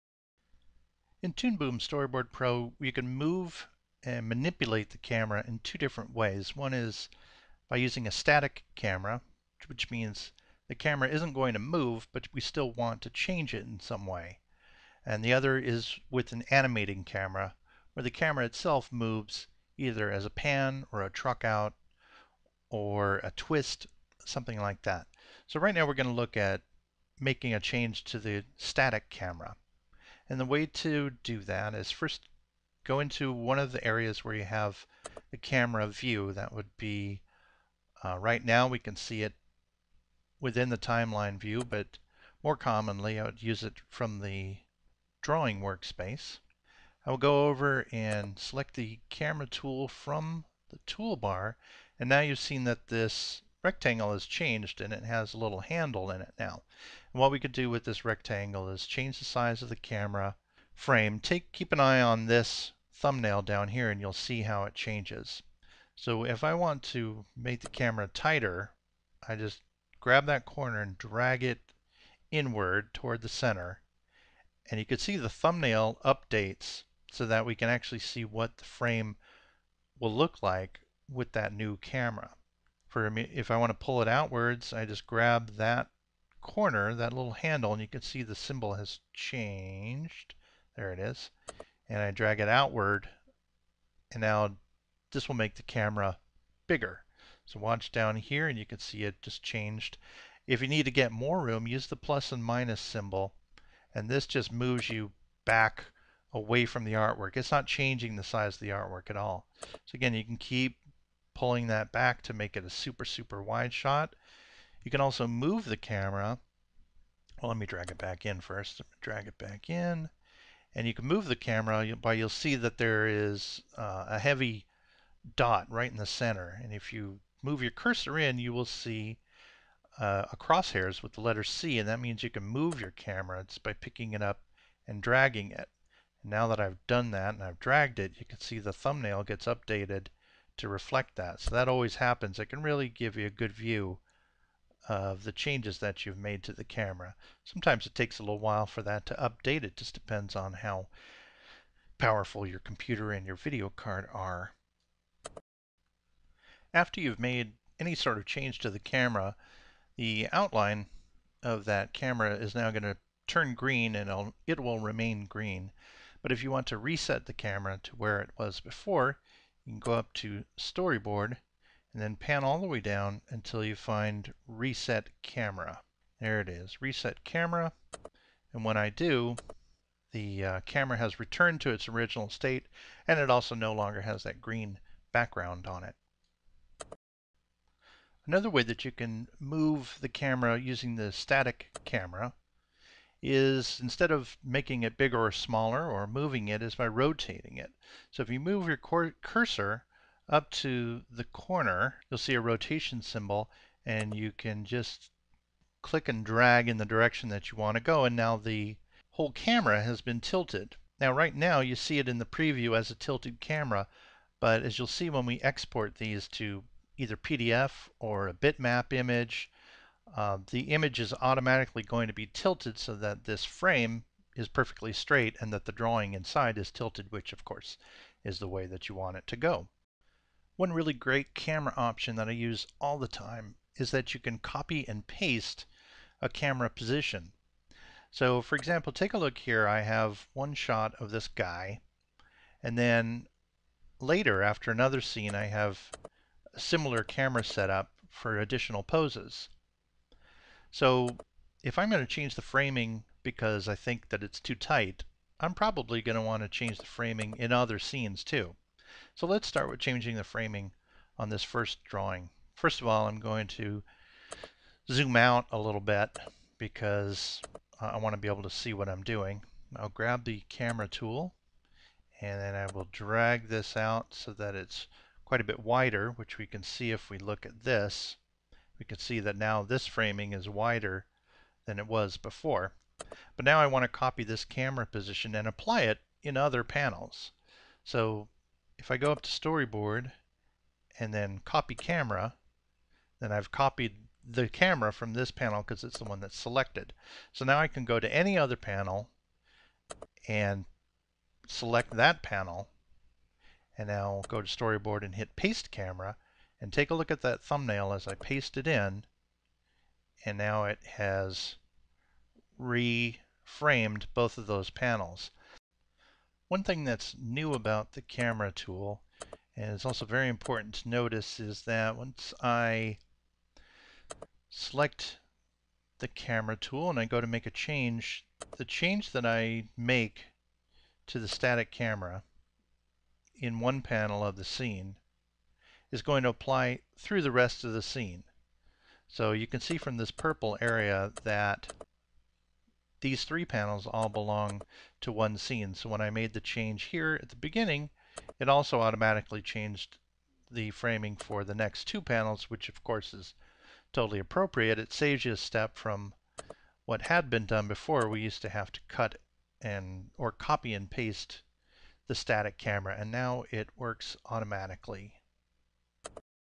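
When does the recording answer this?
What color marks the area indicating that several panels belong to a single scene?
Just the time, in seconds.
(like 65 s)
340 s.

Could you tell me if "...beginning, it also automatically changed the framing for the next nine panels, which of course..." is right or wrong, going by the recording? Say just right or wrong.
wrong.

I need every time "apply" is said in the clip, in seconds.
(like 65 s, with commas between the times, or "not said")
285 s, 336 s.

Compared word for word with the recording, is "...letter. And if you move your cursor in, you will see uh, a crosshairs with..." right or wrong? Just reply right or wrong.
wrong.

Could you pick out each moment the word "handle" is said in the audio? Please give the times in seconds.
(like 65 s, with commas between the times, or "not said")
55 s, 87 s.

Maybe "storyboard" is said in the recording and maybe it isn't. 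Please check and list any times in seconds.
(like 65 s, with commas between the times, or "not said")
1 s, 170 s, 289 s, 304 s.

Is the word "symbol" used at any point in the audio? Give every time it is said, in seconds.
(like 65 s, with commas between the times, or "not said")
88 s, 102 s, 203 s.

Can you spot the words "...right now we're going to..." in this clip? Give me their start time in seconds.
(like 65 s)
25 s.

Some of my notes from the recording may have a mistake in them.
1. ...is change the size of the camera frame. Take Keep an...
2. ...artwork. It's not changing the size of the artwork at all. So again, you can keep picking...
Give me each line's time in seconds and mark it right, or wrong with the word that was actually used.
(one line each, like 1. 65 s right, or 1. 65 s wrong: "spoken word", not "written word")
1. 58 s right
2. 106 s wrong: "pulling", not "picking".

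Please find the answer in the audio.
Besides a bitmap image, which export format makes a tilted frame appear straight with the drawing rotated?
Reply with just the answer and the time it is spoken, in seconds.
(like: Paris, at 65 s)
PDF, at 217 s.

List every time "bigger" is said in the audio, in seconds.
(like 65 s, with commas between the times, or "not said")
96 s, 194 s.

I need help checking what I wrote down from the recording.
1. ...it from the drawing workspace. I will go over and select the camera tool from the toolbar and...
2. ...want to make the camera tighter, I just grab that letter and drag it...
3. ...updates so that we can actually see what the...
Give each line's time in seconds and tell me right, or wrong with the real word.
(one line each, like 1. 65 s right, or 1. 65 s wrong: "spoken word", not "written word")
1. 43 s right
2. 66 s wrong: "corner", not "letter"
3. 76 s right.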